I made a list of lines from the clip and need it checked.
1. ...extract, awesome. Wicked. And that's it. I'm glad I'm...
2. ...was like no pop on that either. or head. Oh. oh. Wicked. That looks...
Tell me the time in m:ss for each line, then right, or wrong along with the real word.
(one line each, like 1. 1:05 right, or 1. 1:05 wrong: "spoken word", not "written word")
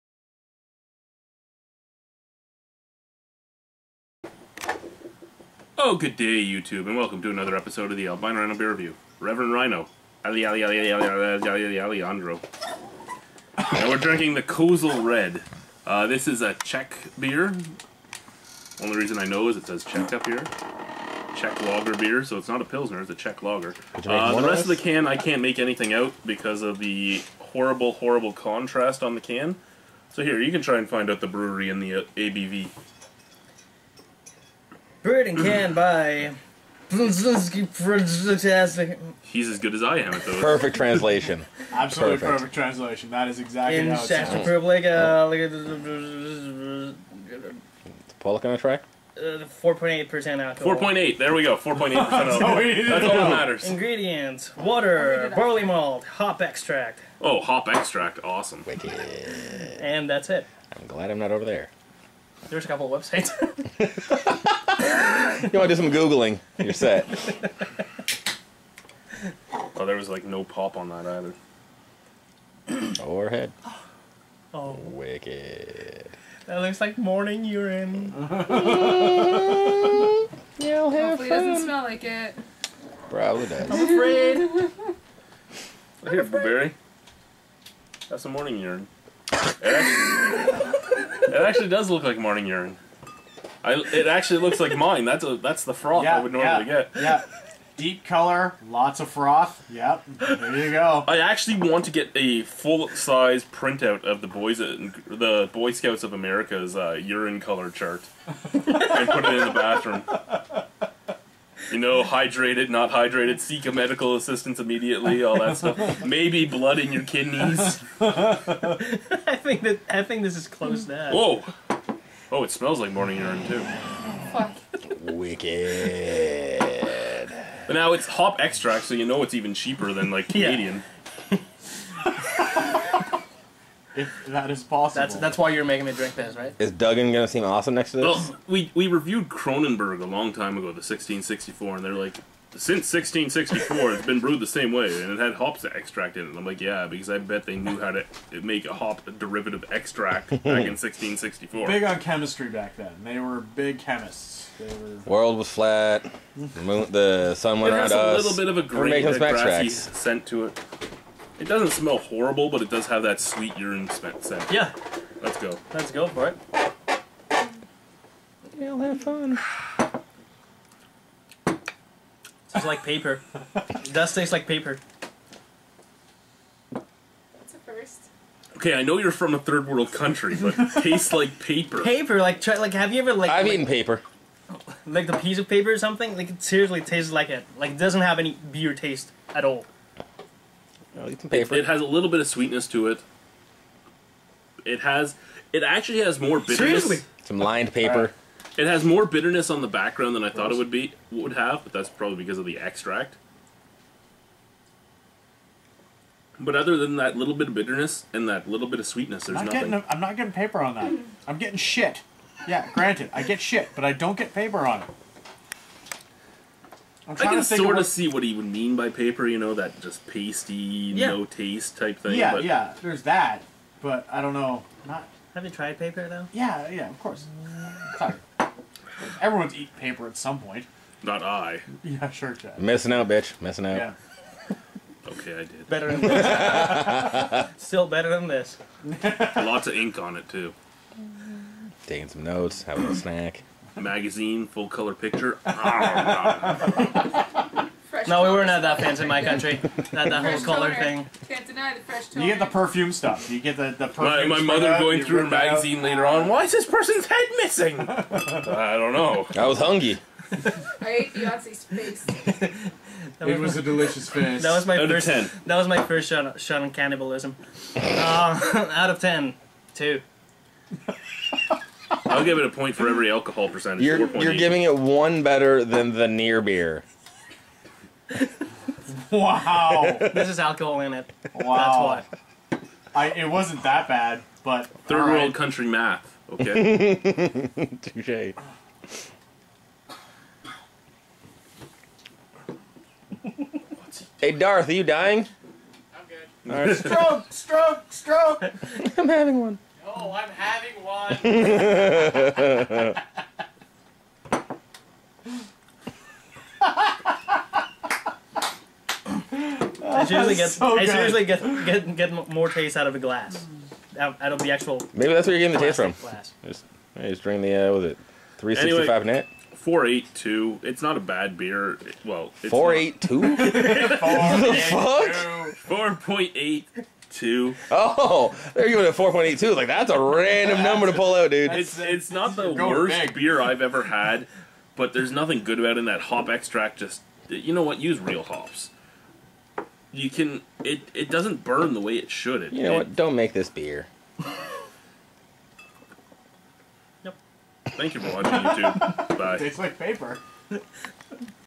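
1. 0:57 right
2. 1:09 right.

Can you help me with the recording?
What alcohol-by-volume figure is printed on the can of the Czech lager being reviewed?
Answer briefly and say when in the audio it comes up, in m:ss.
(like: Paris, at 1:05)
4.8%, at 0:49.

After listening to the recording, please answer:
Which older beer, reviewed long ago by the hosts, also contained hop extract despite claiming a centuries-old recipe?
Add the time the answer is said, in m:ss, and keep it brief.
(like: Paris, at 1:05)
Kronenbourg 1664, at 2:19.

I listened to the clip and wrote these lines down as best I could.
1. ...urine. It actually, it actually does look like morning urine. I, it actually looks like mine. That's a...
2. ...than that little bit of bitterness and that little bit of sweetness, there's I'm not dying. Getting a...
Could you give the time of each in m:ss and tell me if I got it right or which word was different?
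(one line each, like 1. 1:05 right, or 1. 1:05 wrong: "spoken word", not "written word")
1. 1:28 right
2. 3:26 wrong: "nothing", not "dying".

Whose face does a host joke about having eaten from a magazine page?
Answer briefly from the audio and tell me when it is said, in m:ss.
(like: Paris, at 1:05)
Beyonce, at 4:21.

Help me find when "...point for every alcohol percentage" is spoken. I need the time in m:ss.
4:32.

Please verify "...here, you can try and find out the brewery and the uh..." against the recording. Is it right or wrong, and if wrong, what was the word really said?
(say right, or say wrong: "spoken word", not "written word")
right.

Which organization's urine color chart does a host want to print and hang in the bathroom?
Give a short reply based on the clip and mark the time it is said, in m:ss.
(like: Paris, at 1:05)
Boy Scouts of America, at 1:45.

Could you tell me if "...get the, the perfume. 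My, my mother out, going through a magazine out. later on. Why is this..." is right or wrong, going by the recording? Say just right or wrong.
right.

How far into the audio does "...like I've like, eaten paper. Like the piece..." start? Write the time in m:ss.
3:03.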